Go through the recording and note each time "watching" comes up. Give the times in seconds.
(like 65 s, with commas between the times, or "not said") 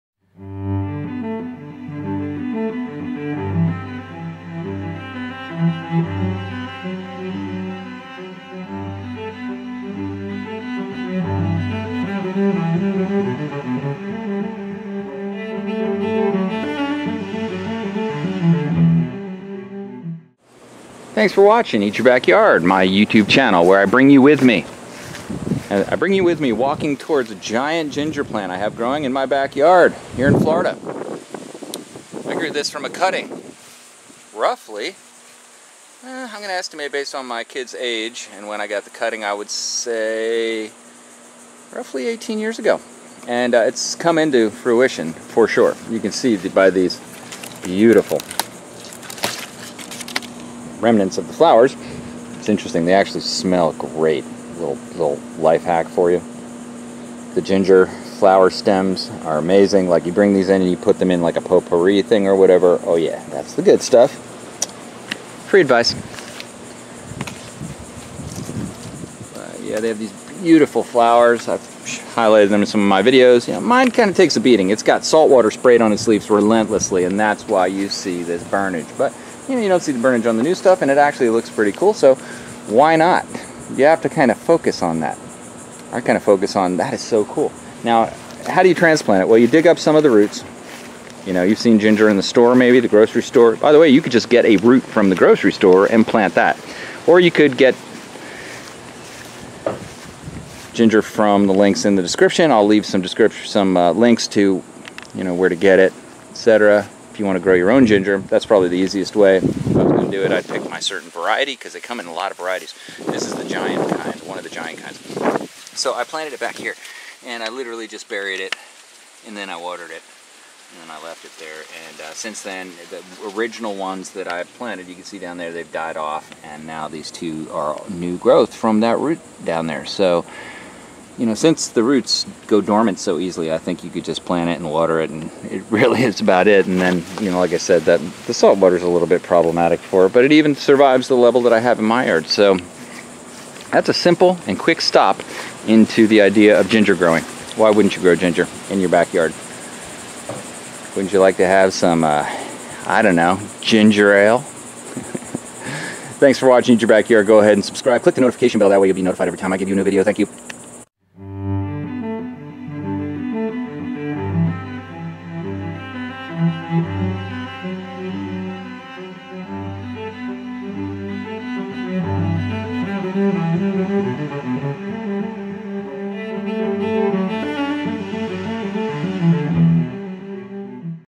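21 s, 156 s.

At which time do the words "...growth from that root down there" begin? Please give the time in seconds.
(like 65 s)
128 s.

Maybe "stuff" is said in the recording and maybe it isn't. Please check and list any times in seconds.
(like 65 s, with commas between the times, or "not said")
63 s, 80 s.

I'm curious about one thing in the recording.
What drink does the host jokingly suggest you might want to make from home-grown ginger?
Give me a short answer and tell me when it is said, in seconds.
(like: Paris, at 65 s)
ginger ale, at 153 s.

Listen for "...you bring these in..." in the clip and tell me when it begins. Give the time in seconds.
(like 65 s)
60 s.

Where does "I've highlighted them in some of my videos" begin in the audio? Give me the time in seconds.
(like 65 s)
71 s.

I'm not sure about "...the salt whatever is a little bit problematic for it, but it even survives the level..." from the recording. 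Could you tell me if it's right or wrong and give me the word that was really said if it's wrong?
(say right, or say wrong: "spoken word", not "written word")
wrong: "water", not "whatever".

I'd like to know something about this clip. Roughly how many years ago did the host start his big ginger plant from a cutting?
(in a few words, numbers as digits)
18.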